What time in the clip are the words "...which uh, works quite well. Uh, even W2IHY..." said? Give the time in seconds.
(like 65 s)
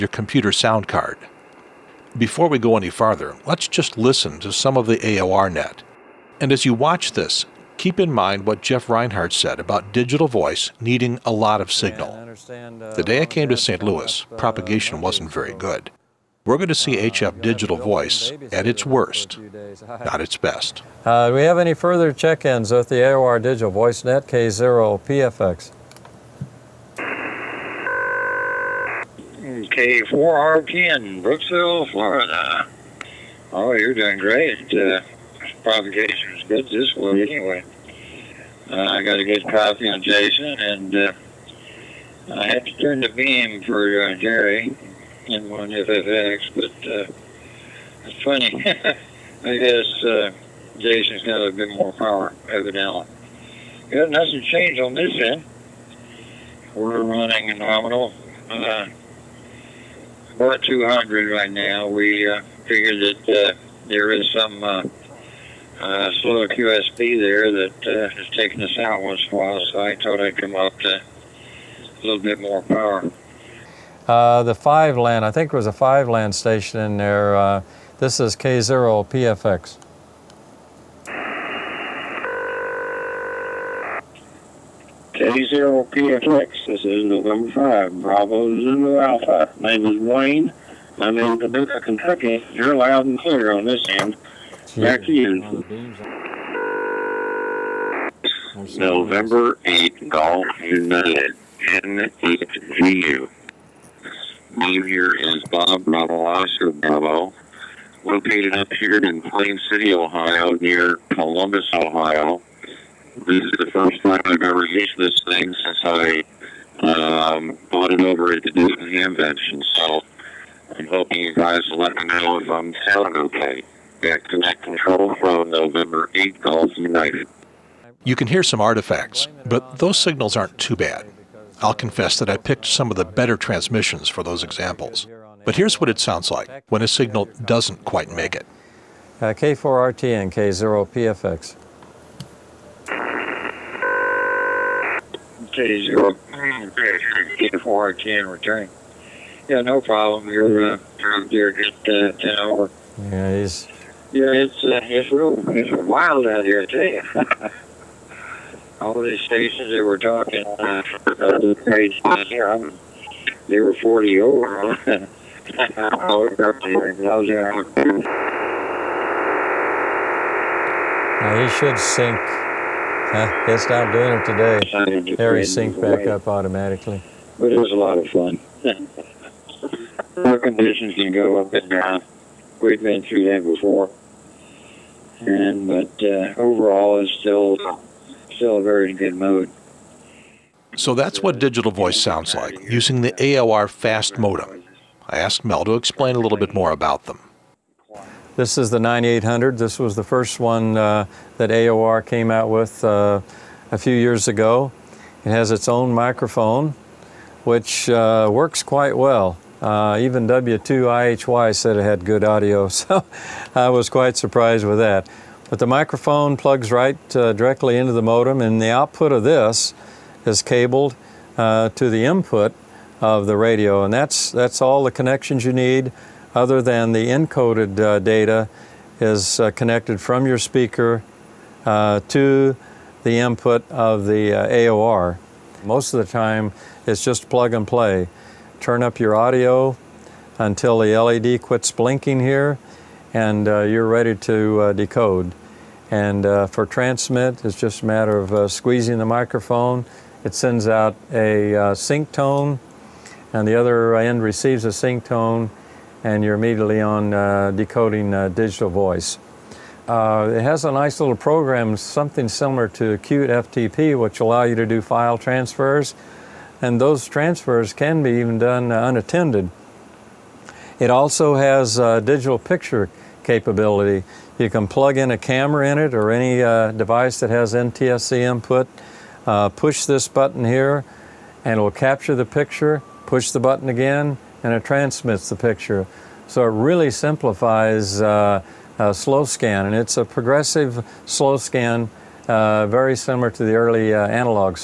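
207 s.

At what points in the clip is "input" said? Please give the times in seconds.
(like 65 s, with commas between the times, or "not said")
222 s, 233 s, 278 s.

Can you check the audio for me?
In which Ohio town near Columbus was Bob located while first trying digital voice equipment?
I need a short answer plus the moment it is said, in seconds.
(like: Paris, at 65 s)
Plain City, at 109 s.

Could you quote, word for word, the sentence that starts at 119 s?
So I'm hoping you guys will let me know if I'm sounding okay.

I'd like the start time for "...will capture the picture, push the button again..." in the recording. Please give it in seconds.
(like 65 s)
281 s.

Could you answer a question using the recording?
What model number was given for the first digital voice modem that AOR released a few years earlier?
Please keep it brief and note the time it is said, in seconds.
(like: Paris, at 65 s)
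9800, at 198 s.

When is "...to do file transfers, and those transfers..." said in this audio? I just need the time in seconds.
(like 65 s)
264 s.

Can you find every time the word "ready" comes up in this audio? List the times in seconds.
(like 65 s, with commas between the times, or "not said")
243 s.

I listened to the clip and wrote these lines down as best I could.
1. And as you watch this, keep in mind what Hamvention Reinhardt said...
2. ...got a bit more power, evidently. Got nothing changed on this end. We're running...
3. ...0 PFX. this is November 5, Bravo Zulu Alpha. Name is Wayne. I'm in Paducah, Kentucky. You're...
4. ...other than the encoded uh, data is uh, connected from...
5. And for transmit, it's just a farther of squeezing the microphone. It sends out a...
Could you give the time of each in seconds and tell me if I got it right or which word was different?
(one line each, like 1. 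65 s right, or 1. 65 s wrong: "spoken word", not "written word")
1. 6 s wrong: "Jeff", not "Hamvention"
2. 51 s right
3. 85 s right
4. 226 s right
5. 245 s wrong: "matter", not "farther".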